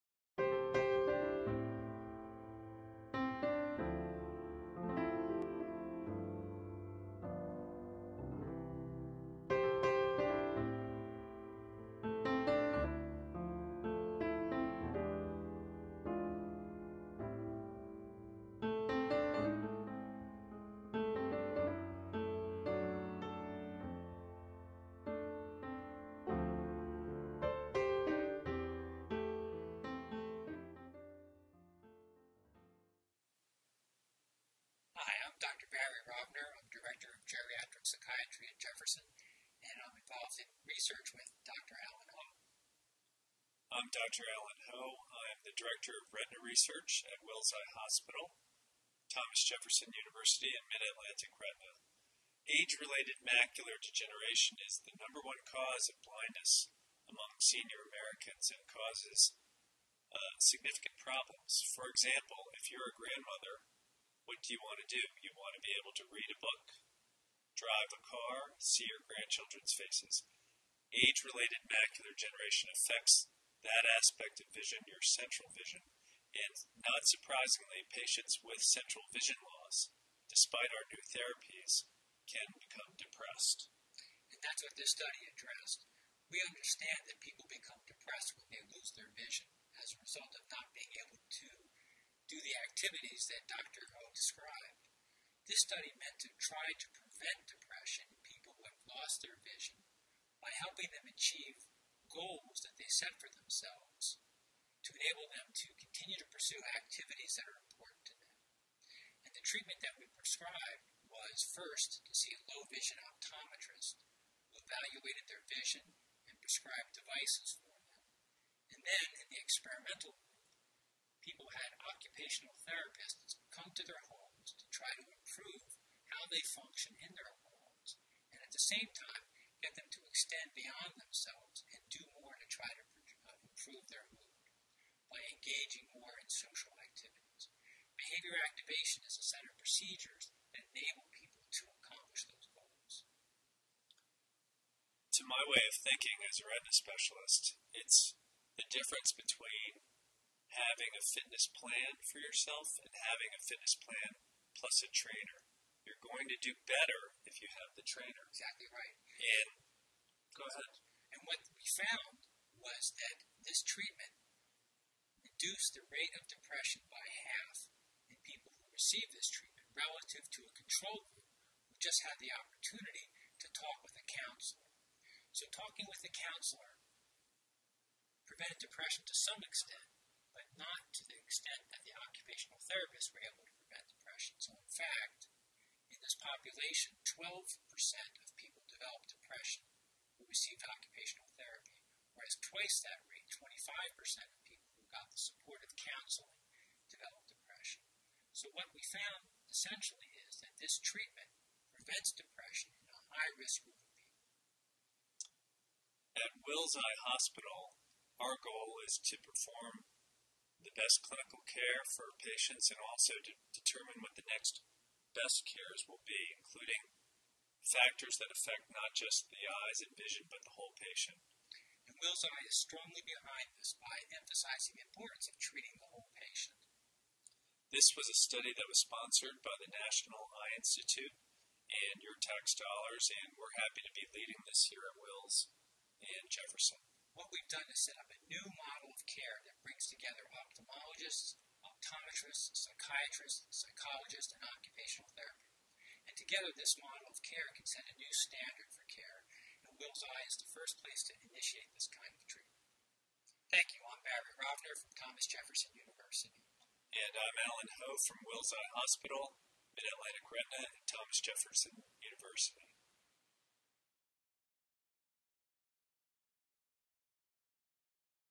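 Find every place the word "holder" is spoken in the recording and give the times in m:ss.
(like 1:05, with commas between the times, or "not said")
not said.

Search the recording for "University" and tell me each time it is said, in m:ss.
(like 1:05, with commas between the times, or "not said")
0:49, 4:15, 4:22.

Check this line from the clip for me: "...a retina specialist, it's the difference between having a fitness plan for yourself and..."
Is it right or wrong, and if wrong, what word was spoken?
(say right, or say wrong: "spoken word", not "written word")
right.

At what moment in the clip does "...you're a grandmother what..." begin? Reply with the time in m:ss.
1:02.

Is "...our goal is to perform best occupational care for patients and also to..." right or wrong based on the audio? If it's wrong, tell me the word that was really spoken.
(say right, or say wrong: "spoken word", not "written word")
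wrong: "clinical", not "occupational".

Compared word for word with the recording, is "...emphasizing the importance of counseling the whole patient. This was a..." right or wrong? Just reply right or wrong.
wrong.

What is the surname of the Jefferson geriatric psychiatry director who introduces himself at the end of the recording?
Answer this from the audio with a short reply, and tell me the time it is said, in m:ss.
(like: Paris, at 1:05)
Rovner, at 4:14.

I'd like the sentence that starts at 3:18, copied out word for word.
So, what we found essentially is that this treatment prevents depression in a high risk group of people.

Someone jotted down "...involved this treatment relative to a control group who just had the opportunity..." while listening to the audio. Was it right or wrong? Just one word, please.
wrong.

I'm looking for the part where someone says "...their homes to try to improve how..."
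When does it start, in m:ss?
2:03.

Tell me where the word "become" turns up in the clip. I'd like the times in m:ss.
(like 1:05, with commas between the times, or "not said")
1:22, 1:27.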